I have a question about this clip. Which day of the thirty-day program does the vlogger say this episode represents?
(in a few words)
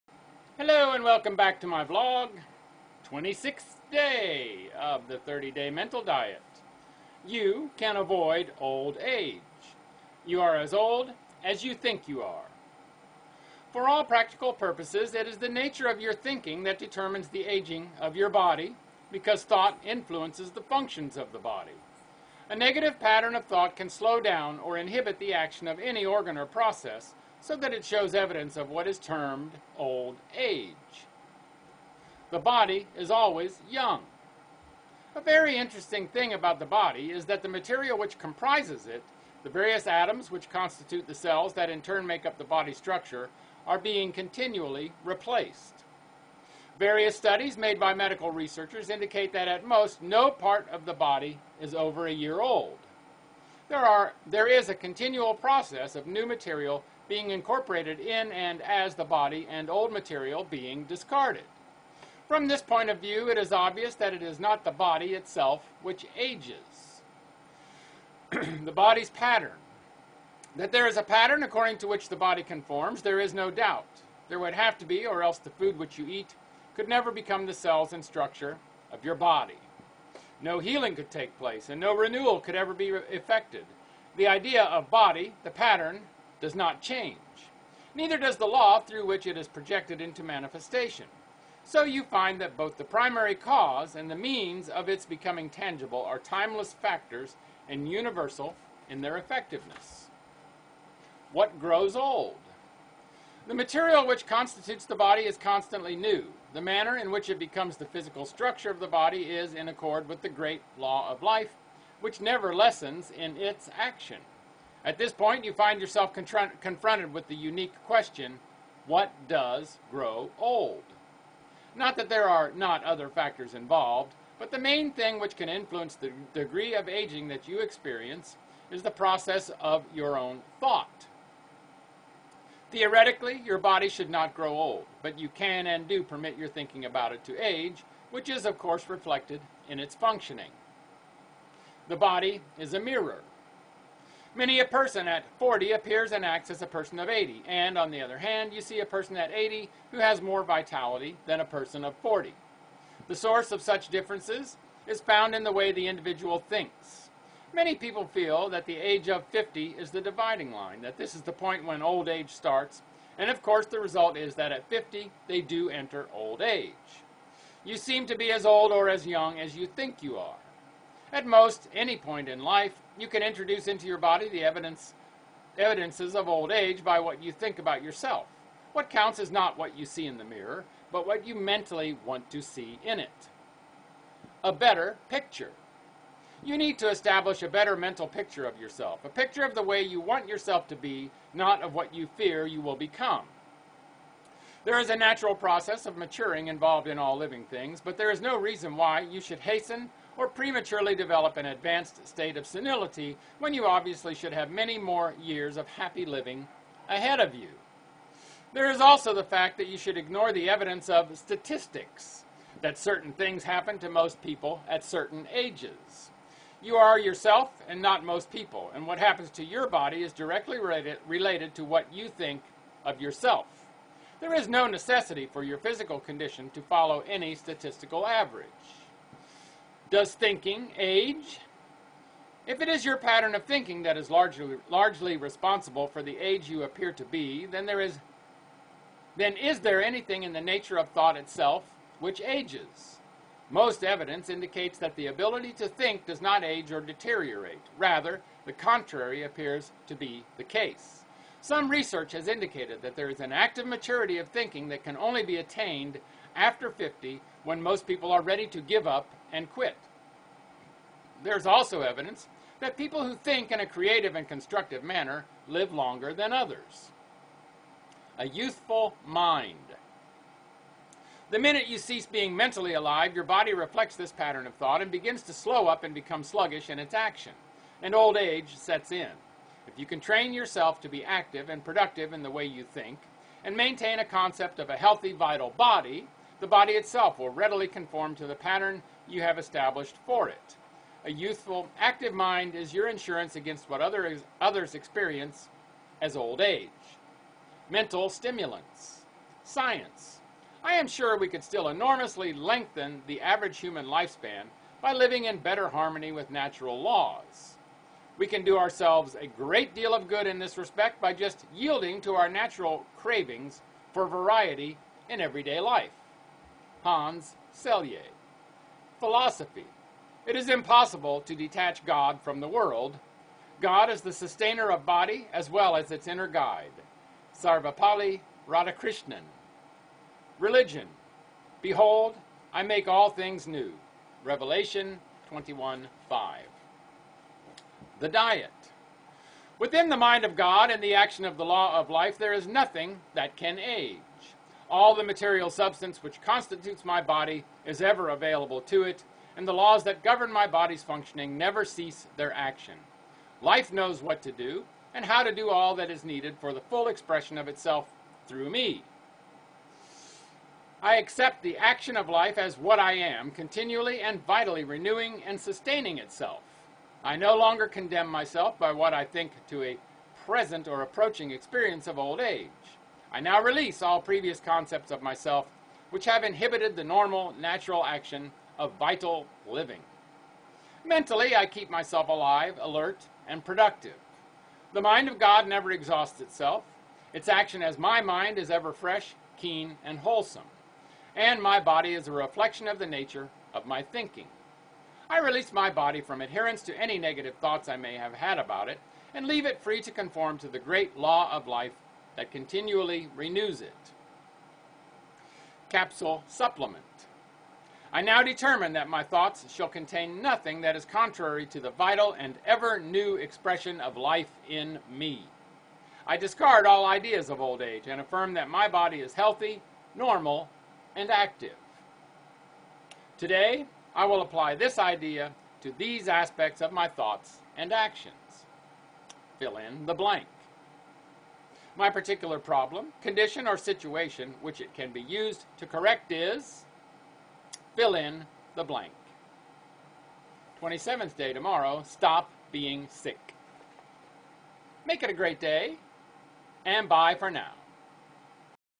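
26th.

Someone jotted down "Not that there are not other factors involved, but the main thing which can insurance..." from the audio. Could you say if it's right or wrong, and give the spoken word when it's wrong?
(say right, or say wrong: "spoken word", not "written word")
wrong: "influence", not "insurance".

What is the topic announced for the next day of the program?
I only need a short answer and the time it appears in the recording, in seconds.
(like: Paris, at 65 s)
Stop being sick, at 441 s.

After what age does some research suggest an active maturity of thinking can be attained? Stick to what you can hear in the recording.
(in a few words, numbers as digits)
50.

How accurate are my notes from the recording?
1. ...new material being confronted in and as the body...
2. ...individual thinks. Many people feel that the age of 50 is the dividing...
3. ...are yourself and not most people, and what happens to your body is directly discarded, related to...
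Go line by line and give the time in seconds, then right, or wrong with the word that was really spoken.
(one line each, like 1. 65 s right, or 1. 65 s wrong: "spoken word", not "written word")
1. 56 s wrong: "incorporated", not "confronted"
2. 155 s right
3. 216 s wrong: "related", not "discarded".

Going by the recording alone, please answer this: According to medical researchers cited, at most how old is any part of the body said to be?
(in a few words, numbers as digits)
a year.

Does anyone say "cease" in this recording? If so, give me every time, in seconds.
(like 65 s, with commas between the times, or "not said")
271 s, 351 s.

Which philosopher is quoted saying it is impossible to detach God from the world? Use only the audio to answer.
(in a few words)
Sarvepalli Radhakrishnan.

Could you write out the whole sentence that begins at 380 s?
Mentally, I keep myself alive, alert, and productive.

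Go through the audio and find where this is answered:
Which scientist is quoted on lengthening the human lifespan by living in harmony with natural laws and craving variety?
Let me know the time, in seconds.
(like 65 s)
316 s.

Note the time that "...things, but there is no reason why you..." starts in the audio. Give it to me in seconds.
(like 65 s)
197 s.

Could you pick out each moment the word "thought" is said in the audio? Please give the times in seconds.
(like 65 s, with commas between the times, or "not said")
19 s, 23 s, 130 s, 240 s, 274 s, 397 s, 409 s, 426 s.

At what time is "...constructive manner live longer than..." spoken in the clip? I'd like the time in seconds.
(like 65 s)
264 s.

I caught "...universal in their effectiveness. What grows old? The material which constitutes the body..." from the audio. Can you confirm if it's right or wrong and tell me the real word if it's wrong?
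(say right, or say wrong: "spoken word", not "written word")
right.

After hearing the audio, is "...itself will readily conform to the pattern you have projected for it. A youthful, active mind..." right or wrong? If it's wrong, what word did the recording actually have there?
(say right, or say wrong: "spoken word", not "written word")
wrong: "established", not "projected".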